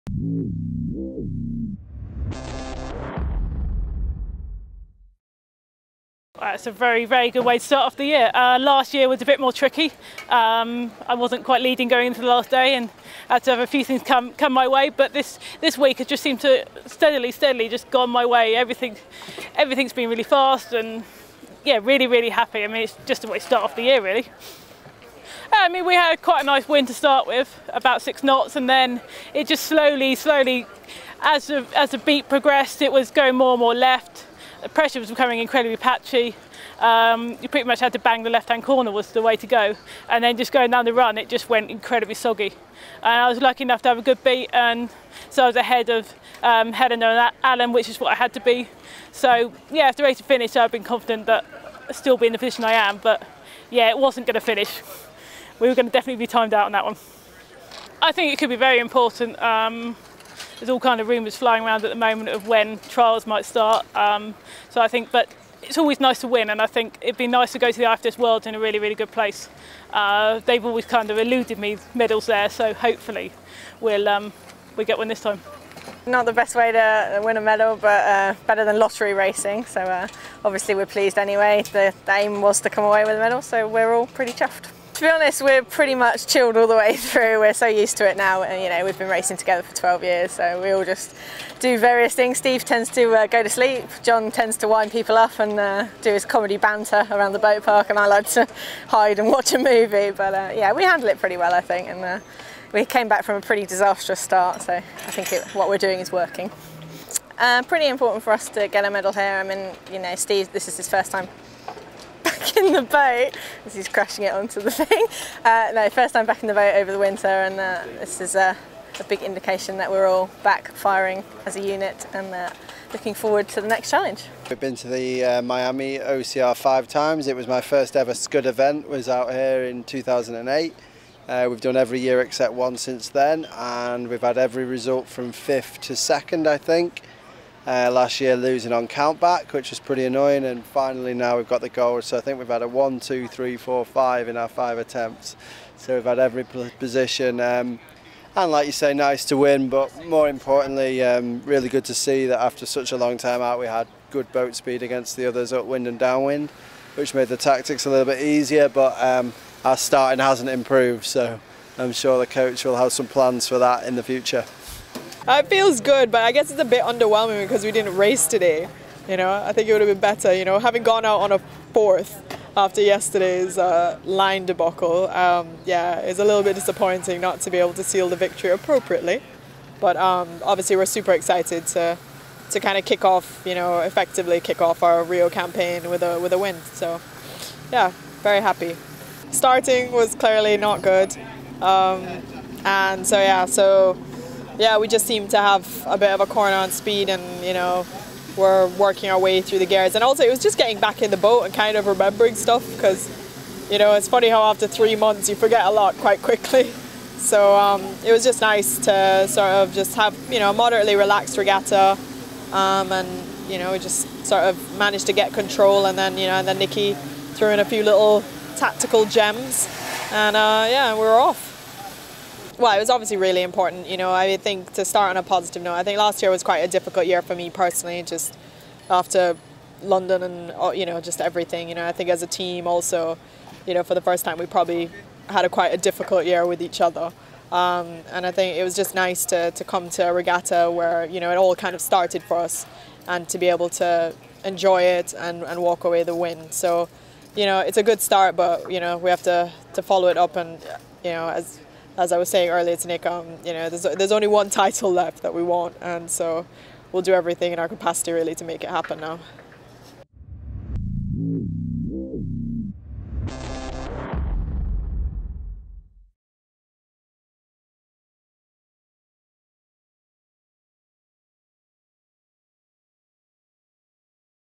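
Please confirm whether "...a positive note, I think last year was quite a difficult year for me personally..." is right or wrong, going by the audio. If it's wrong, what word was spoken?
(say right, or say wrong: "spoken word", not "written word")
right.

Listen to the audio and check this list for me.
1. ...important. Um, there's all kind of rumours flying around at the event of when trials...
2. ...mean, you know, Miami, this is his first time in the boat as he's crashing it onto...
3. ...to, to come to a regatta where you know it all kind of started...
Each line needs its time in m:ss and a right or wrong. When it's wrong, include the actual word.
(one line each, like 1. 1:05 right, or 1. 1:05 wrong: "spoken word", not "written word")
1. 0:58 wrong: "moment", not "event"
2. 1:49 wrong: "Steve", not "Miami"
3. 3:59 right.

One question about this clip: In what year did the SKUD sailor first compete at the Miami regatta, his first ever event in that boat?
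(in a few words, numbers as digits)
2008.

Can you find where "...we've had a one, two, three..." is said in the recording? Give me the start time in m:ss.
2:22.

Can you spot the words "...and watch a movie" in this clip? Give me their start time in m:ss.
1:39.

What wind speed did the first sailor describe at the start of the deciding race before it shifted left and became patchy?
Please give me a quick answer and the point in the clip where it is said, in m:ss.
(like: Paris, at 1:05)
6 knots, at 0:28.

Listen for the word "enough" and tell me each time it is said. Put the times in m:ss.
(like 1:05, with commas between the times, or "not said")
0:43.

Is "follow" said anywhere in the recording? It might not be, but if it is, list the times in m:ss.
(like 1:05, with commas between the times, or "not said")
4:09.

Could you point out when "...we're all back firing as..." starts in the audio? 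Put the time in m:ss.
1:59.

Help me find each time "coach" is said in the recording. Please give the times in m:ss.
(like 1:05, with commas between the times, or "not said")
2:42.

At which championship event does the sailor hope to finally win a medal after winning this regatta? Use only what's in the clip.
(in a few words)
IFDS World.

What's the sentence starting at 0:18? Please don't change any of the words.
Everything, everything's been really fast and yeah, really, really happy.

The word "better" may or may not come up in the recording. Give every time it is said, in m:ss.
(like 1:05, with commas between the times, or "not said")
1:18, 2:49.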